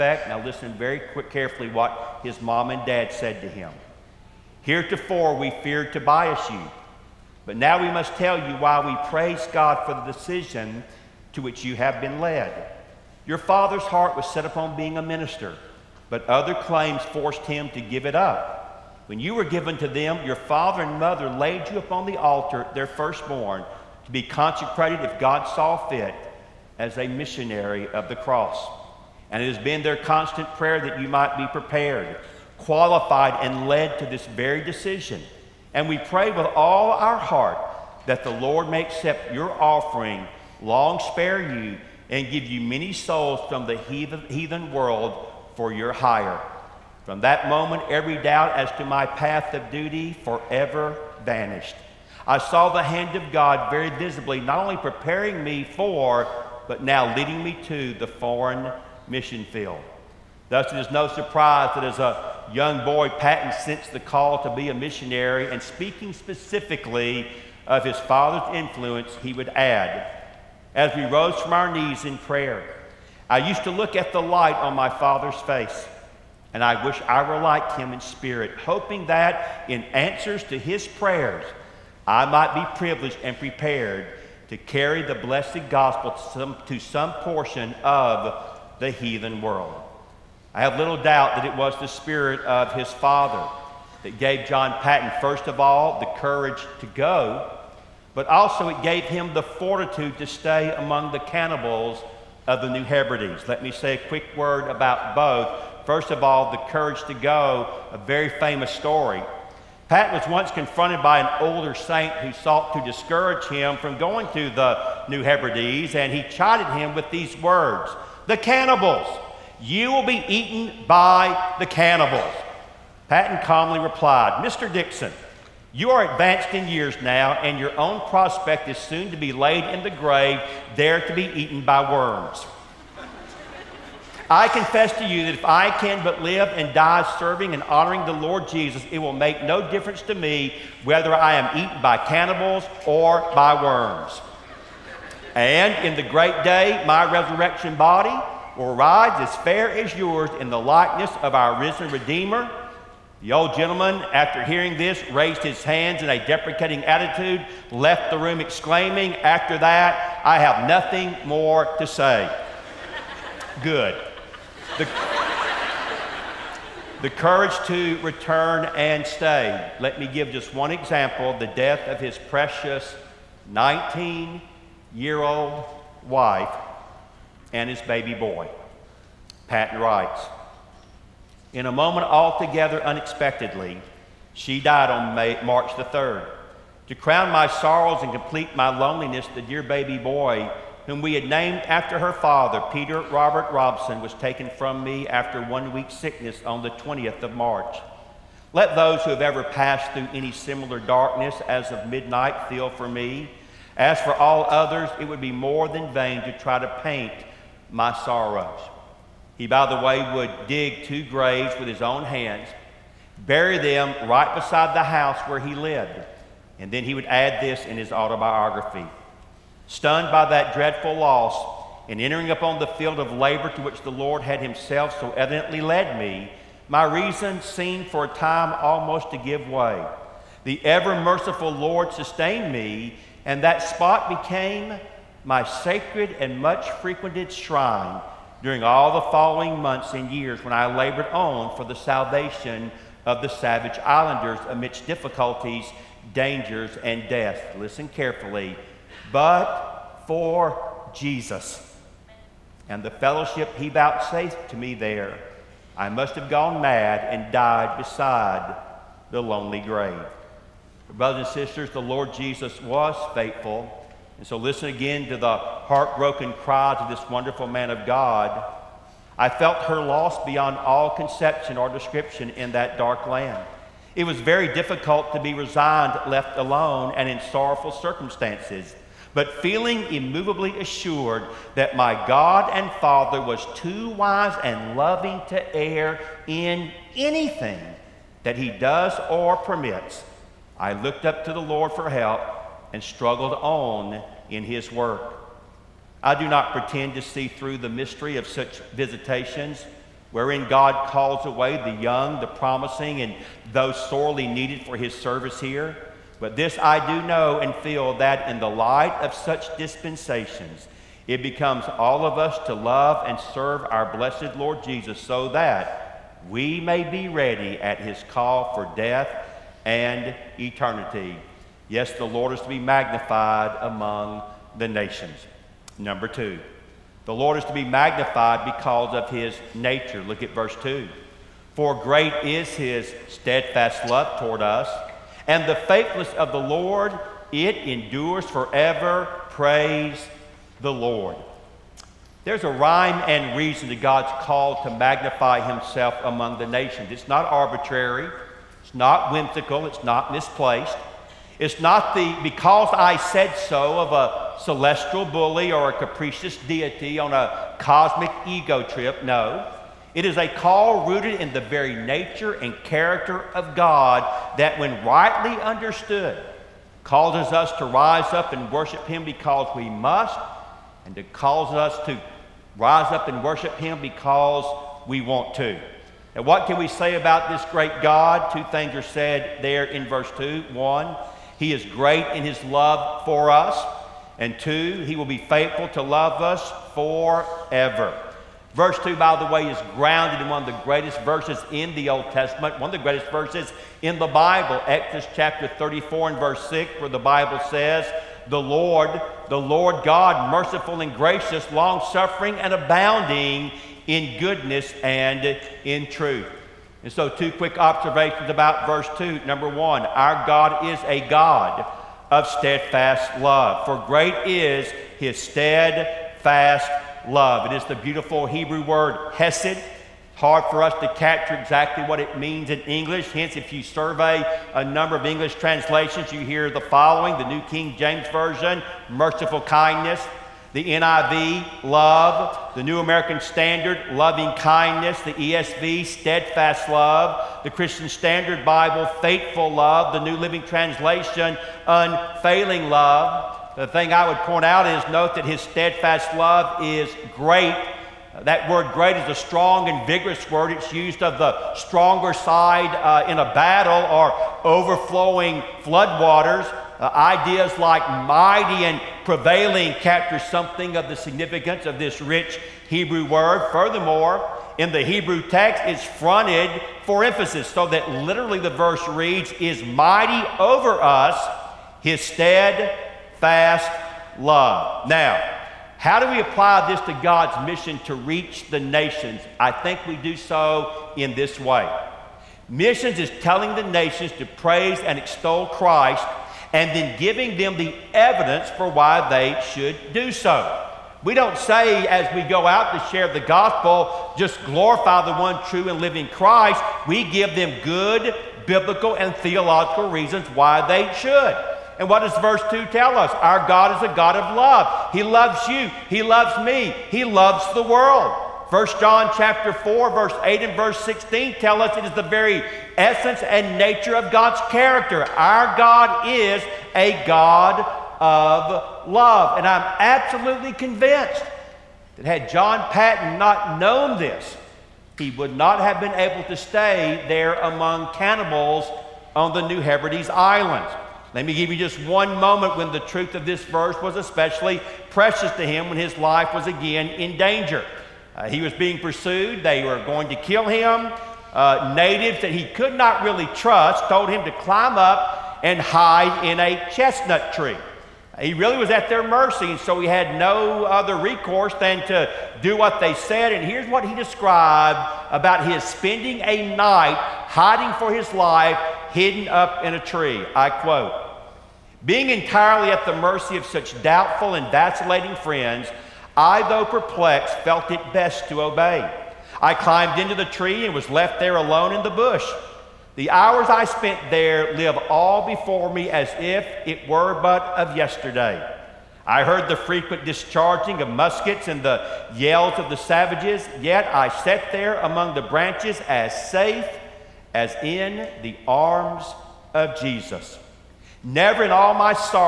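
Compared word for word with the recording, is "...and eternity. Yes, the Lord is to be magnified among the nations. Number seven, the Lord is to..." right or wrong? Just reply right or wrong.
wrong.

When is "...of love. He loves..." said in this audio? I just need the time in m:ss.
8:24.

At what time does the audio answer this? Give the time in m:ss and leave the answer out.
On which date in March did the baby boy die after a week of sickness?
3:16.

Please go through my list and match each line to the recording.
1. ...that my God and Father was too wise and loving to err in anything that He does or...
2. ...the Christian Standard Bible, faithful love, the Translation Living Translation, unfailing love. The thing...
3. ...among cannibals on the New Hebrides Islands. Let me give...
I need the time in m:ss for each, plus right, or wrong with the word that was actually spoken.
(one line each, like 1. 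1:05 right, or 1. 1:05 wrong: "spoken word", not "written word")
1. 4:41 right
2. 7:17 wrong: "New", not "Translation"
3. 8:47 right.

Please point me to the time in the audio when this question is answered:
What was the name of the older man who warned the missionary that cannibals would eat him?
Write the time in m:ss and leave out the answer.
2:04.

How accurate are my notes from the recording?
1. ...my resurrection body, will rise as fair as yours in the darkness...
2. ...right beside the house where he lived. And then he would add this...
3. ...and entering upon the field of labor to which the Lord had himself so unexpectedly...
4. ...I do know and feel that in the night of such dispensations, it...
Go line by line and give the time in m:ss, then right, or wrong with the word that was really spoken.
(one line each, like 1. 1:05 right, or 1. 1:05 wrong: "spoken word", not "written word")
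1. 2:26 wrong: "likeness", not "darkness"
2. 3:34 right
3. 3:41 wrong: "evidently", not "unexpectedly"
4. 5:06 wrong: "light", not "night".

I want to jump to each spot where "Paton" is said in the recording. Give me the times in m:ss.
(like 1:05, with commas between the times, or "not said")
1:03, 1:34, 2:03, 2:59, 8:42.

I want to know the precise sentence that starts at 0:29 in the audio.
And it has been their constant prayer that you might be prepared qualified and led to this very decision.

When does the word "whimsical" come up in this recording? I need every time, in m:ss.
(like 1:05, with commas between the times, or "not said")
5:49.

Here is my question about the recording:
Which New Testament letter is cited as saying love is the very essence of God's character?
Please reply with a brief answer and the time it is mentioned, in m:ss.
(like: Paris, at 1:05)
First John, at 8:28.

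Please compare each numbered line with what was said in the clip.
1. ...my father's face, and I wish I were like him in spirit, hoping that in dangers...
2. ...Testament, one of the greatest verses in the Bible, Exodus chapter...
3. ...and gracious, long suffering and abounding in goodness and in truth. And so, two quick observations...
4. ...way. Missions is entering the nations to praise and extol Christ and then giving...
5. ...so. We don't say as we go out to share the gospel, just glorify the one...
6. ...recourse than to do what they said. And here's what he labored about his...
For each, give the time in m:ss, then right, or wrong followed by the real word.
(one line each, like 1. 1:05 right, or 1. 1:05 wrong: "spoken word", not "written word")
1. 1:14 wrong: "answers", not "dangers"
2. 6:32 right
3. 6:40 right
4. 8:01 wrong: "telling", not "entering"
5. 8:10 right
6. 9:10 wrong: "described", not "labored".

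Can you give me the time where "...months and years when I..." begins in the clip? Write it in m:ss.
3:59.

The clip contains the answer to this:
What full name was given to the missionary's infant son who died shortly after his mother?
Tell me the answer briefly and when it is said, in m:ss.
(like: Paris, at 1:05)
Peter Robert Robson, at 3:12.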